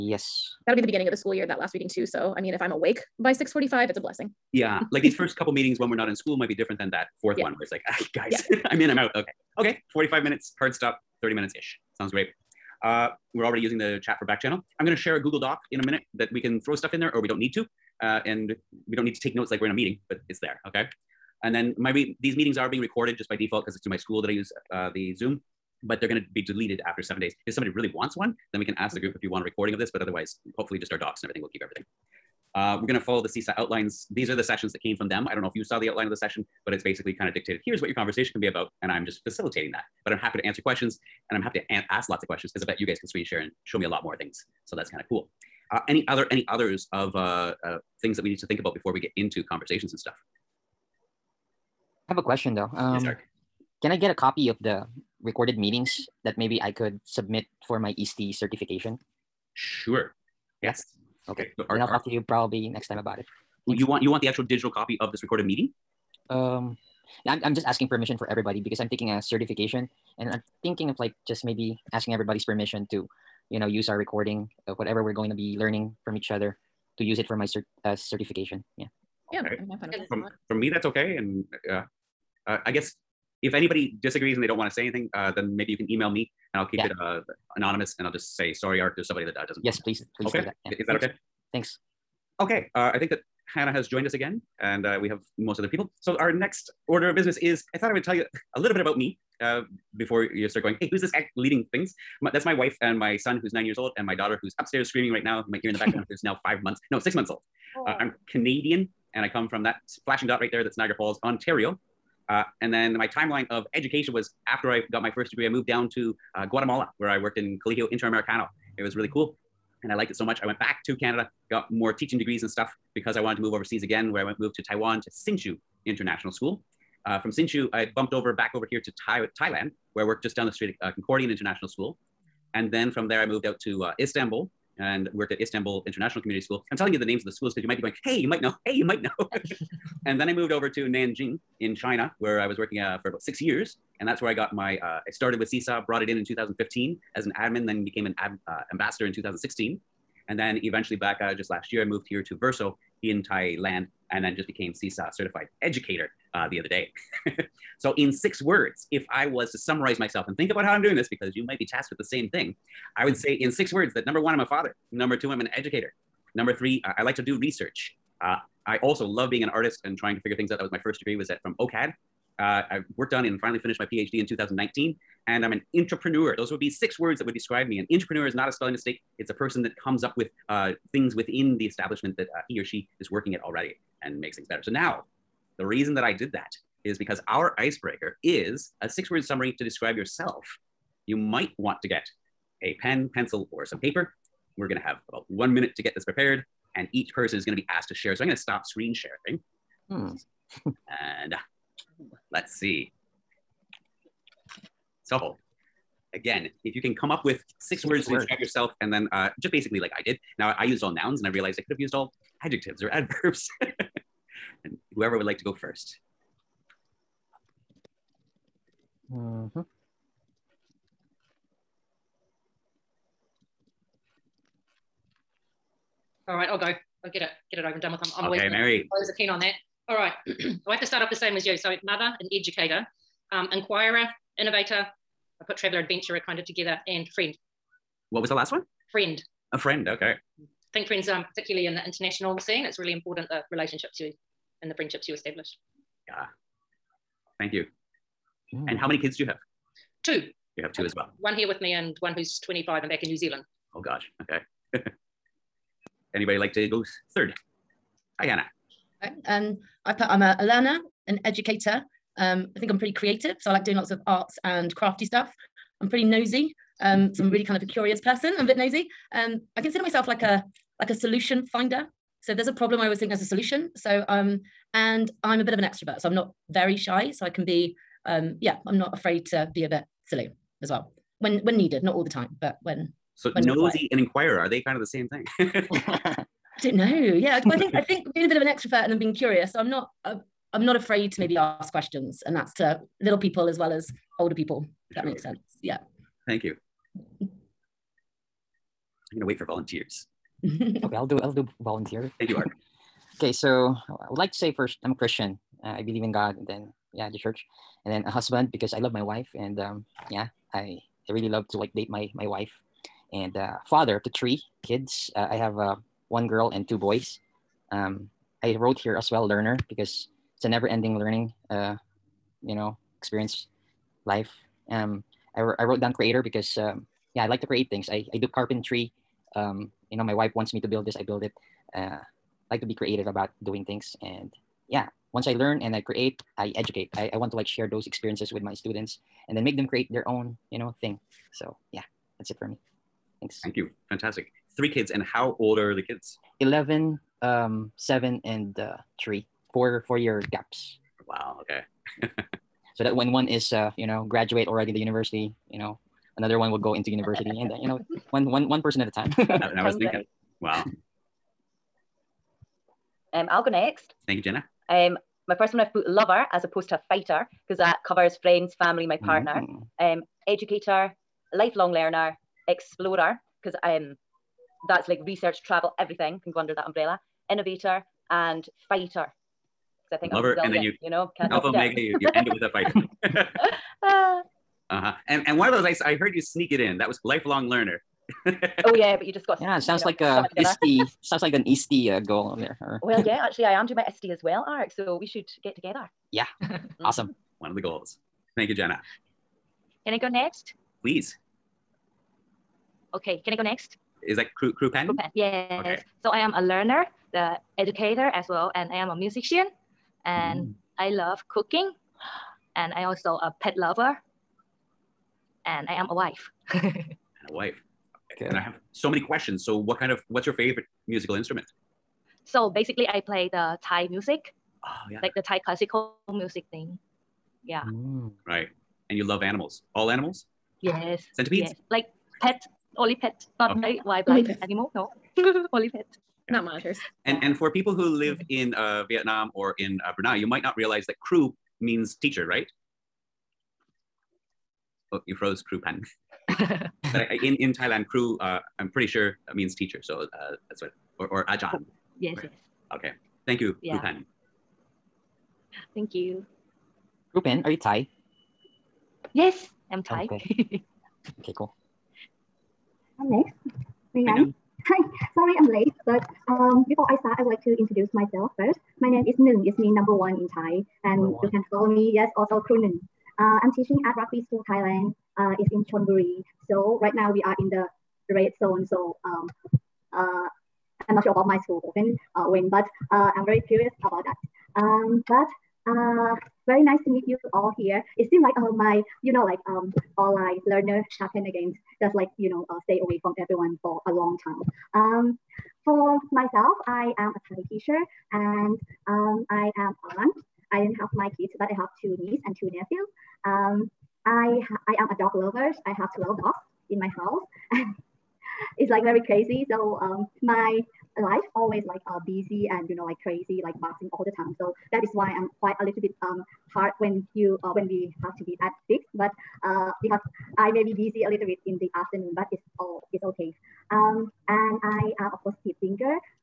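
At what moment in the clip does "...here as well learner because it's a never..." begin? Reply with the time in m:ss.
5:18.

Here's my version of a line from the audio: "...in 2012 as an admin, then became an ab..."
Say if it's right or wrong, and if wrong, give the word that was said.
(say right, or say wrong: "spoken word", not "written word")
wrong: "2015", not "2012".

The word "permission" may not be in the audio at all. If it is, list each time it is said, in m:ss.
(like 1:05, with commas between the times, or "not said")
1:07, 1:12.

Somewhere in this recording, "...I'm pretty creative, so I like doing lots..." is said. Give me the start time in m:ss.
4:22.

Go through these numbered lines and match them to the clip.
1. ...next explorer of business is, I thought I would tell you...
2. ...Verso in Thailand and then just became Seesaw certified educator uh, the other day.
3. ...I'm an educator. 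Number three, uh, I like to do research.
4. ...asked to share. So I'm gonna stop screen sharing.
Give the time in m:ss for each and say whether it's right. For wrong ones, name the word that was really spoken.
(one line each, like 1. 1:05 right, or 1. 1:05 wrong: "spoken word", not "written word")
1. 1:36 wrong: "order", not "explorer"
2. 2:32 right
3. 2:45 right
4. 3:17 right.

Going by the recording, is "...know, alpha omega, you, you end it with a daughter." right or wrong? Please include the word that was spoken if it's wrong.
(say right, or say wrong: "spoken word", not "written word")
wrong: "fighter", not "daughter".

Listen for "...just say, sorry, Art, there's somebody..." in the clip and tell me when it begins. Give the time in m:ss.
1:28.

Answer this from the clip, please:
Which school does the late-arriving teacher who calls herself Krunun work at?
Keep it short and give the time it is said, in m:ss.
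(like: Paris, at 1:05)
Rugby School Thailand, at 7:53.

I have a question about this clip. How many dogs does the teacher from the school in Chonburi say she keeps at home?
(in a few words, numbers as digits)
12.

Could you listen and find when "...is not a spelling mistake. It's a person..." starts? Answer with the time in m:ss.
2:58.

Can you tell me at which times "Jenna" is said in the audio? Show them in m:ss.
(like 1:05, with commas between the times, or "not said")
6:04, 6:38.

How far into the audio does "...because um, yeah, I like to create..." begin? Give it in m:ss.
5:26.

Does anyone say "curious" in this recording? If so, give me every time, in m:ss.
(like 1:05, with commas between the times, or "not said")
4:27, 4:49, 8:03.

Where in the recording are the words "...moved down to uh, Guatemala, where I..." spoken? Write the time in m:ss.
1:55.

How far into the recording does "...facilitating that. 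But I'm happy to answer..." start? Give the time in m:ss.
0:39.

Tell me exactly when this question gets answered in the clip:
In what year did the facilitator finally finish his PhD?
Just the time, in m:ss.
2:54.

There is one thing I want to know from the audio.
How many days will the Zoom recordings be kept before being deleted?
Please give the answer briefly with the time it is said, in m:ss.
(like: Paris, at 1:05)
7, at 0:27.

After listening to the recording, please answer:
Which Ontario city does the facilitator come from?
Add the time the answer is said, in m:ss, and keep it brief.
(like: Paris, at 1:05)
Niagara Falls, at 1:50.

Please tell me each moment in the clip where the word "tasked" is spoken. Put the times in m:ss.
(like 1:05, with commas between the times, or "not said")
2:41.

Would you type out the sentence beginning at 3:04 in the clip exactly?
So now, the reason that I did that is because our icebreaker is a six word summary to describe yourself.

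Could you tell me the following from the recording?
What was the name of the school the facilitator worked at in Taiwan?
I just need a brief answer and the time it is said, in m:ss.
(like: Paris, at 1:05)
Hsinchu International School, at 2:05.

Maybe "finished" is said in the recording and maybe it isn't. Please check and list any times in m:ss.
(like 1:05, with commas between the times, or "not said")
2:53.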